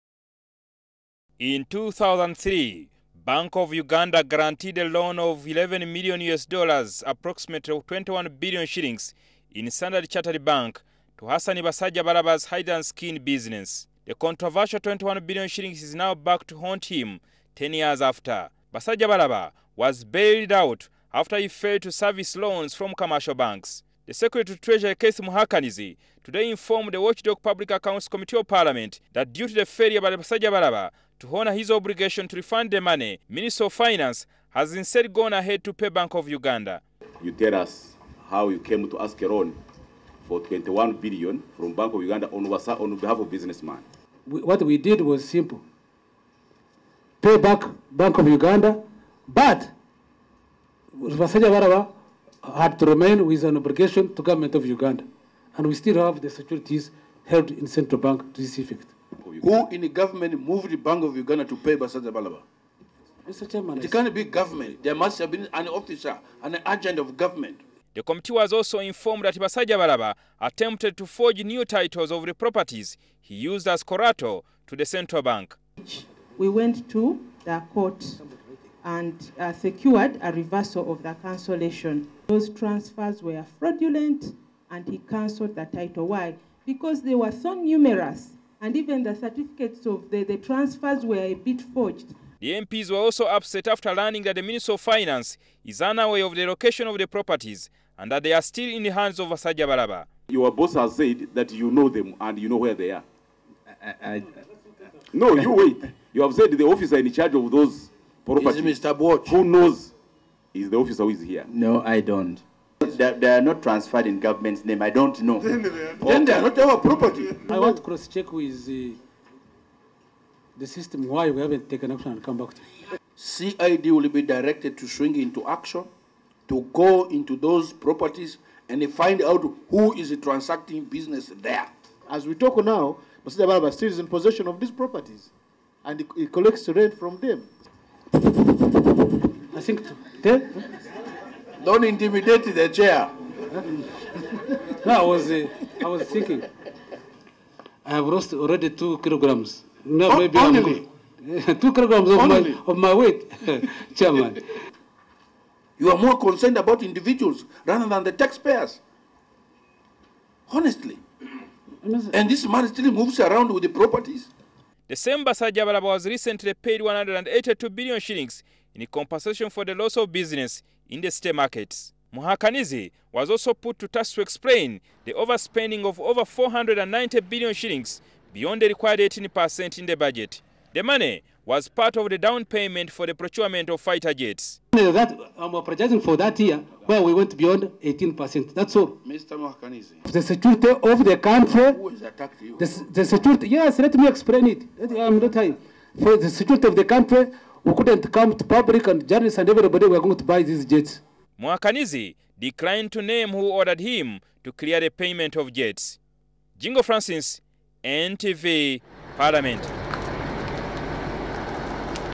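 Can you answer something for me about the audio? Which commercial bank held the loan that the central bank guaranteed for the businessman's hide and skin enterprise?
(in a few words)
Standard Chartered Bank.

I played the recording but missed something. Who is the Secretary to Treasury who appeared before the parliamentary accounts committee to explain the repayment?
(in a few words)
Keith Muhakanizi.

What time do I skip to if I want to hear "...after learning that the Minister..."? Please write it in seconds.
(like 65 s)
93 s.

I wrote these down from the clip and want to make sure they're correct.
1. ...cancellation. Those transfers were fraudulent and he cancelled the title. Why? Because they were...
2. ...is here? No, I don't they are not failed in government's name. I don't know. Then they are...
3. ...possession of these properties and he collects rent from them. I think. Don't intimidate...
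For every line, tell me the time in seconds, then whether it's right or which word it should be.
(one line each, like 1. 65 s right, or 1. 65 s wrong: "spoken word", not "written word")
1. 81 s right
2. 111 s wrong: "transferred", not "failed"
3. 134 s right.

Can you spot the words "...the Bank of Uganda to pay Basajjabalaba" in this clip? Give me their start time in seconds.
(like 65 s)
60 s.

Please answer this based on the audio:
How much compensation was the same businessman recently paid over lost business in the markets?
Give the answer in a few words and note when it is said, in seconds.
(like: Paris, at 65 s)
182 billion shillings, at 166 s.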